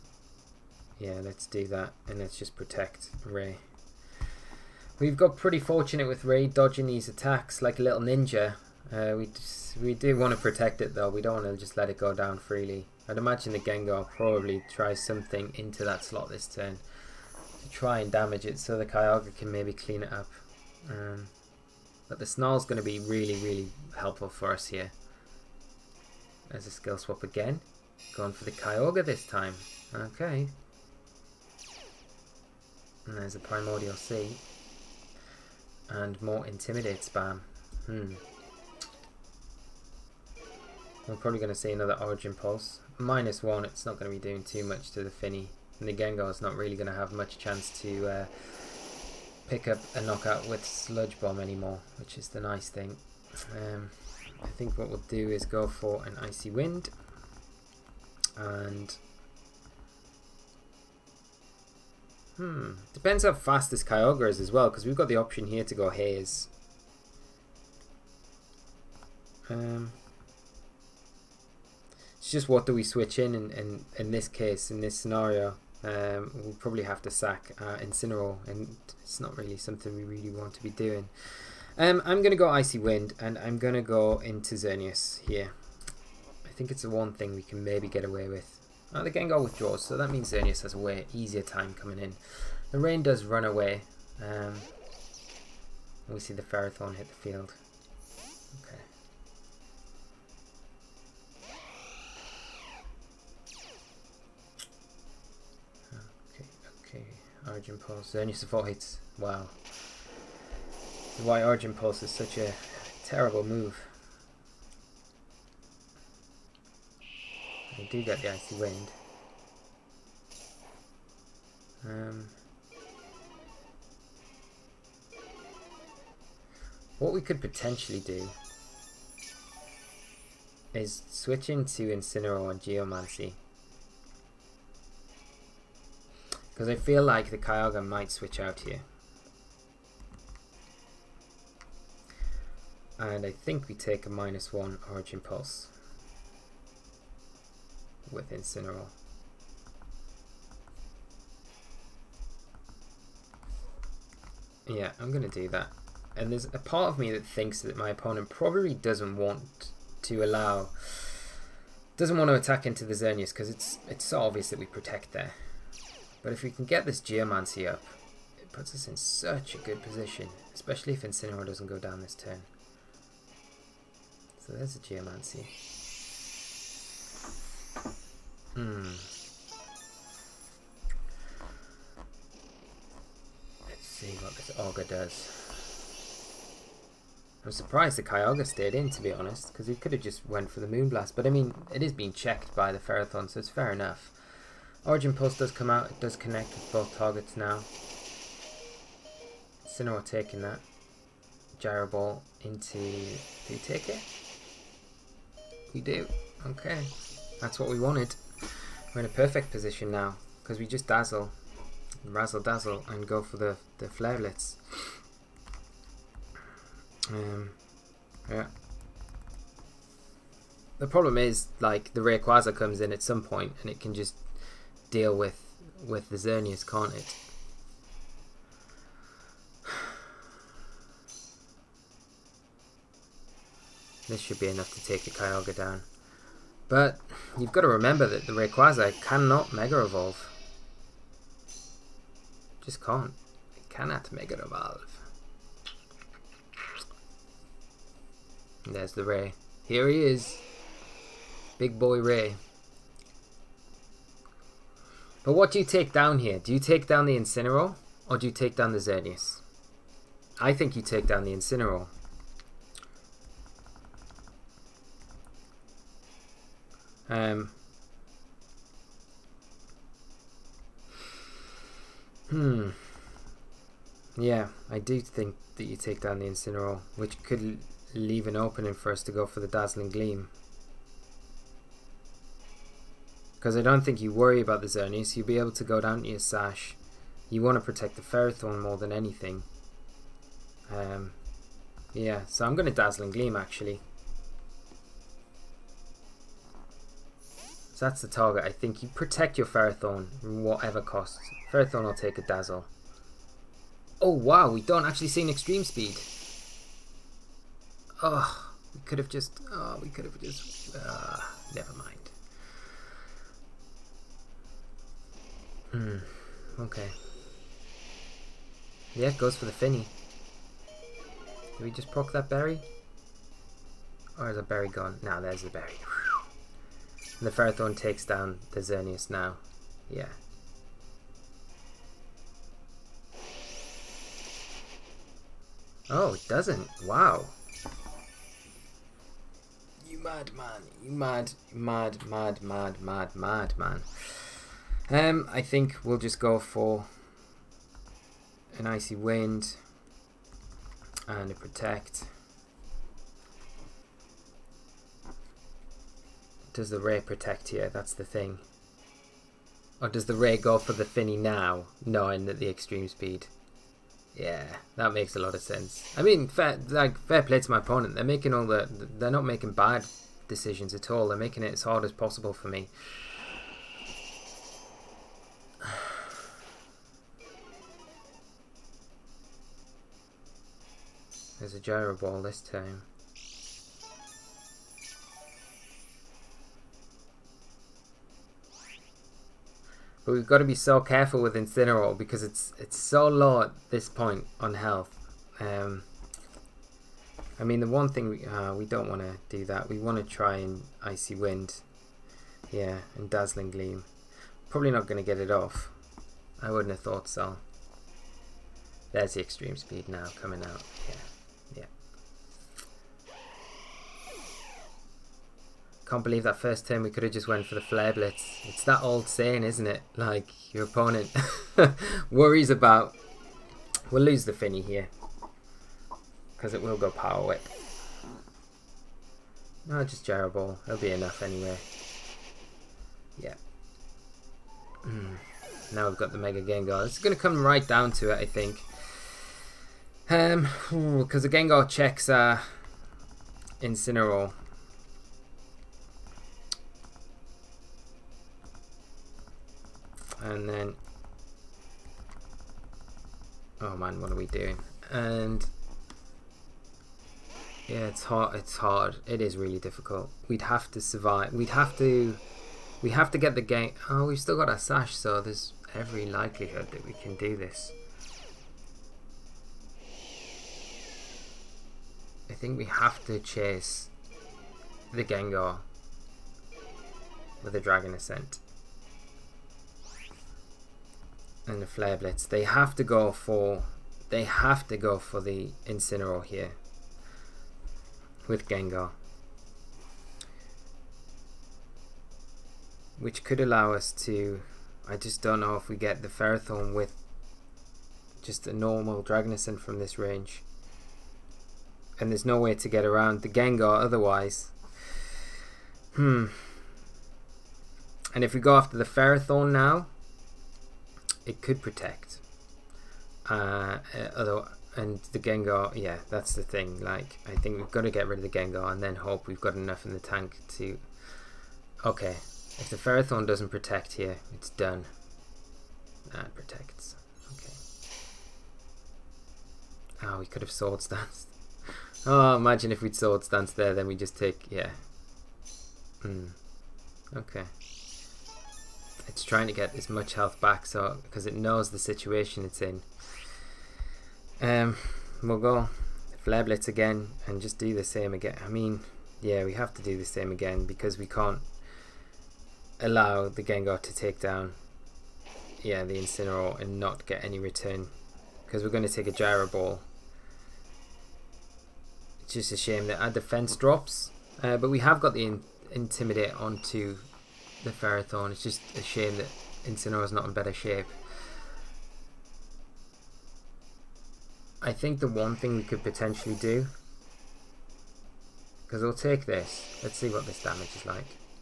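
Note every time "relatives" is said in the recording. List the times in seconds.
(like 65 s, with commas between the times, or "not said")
not said.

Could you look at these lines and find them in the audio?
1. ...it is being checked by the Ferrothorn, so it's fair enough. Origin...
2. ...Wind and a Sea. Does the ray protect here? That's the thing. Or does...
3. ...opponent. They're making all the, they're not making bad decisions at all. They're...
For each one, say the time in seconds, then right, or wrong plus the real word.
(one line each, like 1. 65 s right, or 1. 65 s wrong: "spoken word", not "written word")
1. 191 s right
2. 348 s wrong: "Protect", not "Sea"
3. 367 s right.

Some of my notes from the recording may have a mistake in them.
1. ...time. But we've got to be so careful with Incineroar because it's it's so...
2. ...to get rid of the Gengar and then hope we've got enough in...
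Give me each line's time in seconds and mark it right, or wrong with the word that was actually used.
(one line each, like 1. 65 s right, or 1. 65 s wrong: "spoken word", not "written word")
1. 382 s right
2. 517 s right.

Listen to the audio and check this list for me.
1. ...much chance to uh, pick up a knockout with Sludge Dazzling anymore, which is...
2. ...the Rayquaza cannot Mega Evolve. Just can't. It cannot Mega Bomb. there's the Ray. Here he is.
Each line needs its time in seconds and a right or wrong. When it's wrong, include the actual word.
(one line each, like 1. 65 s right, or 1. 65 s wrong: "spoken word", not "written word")
1. 47 s wrong: "Bomb", not "Dazzling"
2. 238 s wrong: "Evolve", not "Bomb".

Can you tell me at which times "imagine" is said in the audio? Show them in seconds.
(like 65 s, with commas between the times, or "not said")
13 s, 532 s.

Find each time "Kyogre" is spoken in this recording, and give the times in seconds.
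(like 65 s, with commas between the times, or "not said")
18 s, 28 s, 63 s, 137 s, 188 s, 235 s.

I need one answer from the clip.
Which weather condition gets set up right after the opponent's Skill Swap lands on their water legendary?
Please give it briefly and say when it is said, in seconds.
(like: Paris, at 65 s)
Primordial Sea, at 33 s.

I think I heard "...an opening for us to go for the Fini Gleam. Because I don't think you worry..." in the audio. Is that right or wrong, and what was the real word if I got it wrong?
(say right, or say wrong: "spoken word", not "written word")
wrong: "Dazzling", not "Fini".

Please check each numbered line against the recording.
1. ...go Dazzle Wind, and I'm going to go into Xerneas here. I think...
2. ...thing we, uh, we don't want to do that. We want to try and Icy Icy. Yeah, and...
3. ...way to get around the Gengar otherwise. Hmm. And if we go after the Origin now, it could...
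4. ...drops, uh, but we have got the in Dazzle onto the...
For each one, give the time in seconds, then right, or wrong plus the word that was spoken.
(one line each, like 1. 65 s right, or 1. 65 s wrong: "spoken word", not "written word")
1. 82 s wrong: "Icy", not "Dazzle"
2. 397 s wrong: "Wind", not "Icy"
3. 502 s wrong: "Ferrothorn", not "Origin"
4. 563 s wrong: "Intimidate", not "Dazzle".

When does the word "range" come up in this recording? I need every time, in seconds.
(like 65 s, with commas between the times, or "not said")
499 s.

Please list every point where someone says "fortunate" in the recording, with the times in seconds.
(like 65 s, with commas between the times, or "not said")
5 s.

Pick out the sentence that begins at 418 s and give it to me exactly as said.
It's that old saying, isn't it?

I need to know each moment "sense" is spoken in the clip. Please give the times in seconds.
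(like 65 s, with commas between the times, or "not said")
365 s.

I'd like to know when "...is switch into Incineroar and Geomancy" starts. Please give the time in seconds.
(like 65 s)
130 s.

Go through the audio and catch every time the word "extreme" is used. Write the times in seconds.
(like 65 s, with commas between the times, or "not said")
305 s, 362 s, 409 s.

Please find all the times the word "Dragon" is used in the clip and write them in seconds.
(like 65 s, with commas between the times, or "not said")
477 s, 499 s.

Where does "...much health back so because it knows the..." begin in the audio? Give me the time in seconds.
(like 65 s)
539 s.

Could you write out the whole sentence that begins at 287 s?
You want to protect the Ferrothorn more than anything.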